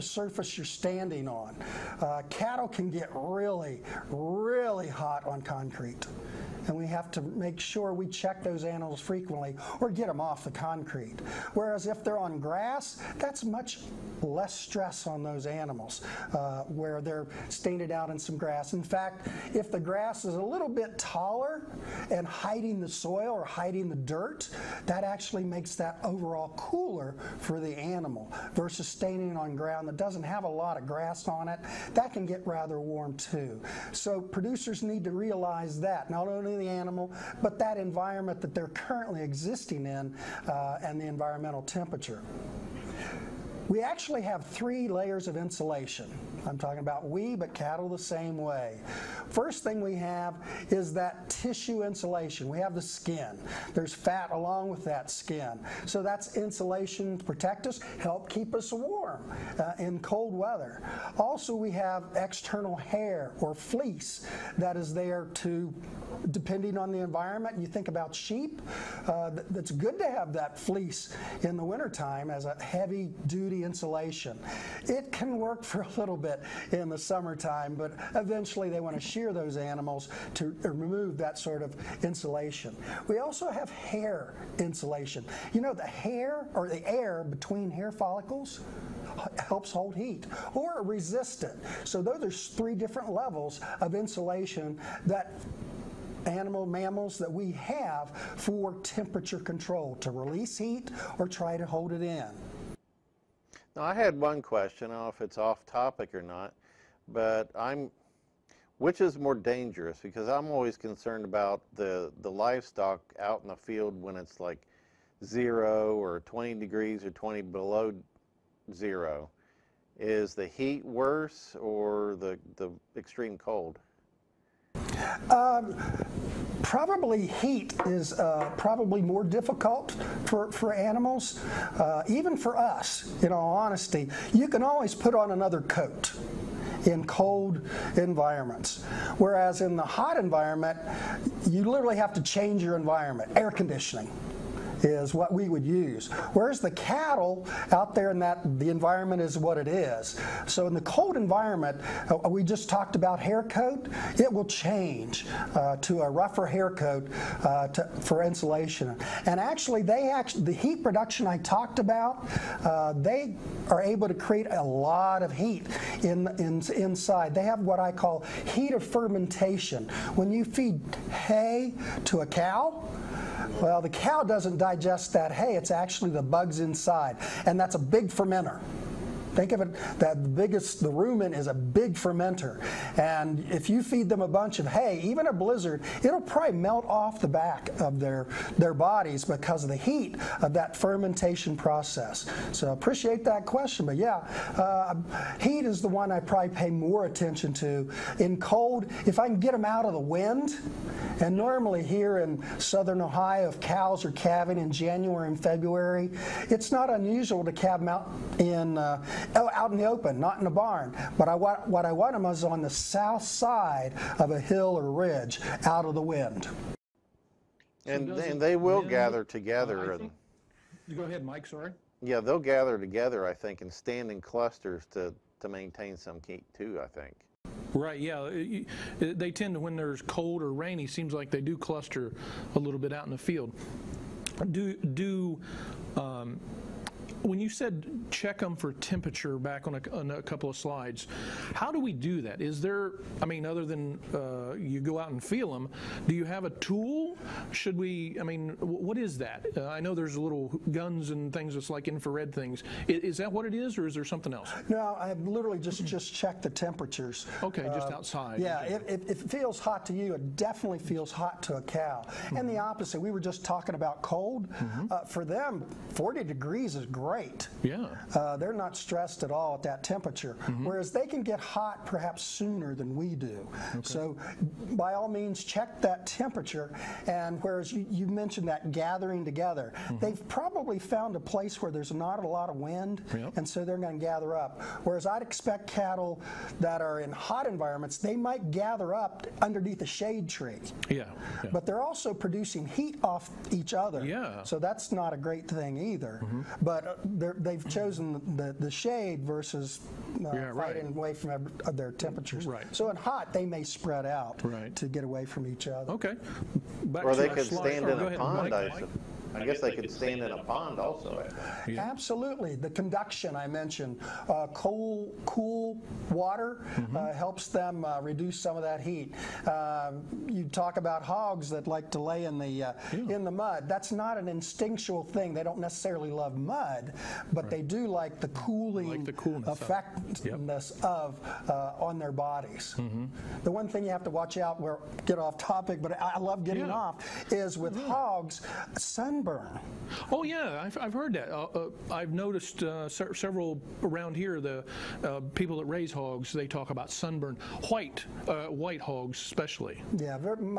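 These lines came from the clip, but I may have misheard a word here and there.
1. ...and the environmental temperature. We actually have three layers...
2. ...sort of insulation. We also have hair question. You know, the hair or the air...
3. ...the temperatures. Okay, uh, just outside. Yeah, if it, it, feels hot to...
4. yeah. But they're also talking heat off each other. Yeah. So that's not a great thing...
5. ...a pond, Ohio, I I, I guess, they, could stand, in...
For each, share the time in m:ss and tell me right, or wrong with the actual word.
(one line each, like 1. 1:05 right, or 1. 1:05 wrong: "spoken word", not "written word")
1. 0:40 right
2. 1:21 wrong: "insulation", not "question"
3. 4:16 right
4. 4:51 wrong: "producing", not "talking"
5. 5:08 wrong: "Mike", not "Ohio".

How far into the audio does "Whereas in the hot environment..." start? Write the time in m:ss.
2:19.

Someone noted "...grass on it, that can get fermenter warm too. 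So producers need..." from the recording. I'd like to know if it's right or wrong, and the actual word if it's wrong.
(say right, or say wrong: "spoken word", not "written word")
wrong: "rather", not "fermenter".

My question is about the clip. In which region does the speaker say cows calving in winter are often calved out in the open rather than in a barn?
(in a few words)
southern Ohio.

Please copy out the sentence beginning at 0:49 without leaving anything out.
First thing we have is that tissue insulation.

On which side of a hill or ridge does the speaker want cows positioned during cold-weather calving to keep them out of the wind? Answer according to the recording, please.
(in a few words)
south side.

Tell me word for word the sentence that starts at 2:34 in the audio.
It will change uh, to a rougher hair coat uh, to, for insulation.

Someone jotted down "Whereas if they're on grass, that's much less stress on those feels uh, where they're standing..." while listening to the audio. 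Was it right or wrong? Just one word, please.
wrong.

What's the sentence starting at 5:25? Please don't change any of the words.
They don't necessarily love mud, but right.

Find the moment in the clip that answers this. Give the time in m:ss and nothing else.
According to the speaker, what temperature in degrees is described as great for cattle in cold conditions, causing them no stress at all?
4:25.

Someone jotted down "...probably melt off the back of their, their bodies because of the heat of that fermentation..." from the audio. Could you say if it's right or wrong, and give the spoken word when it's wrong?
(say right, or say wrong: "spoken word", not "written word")
right.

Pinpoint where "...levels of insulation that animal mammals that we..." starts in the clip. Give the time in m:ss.
1:33.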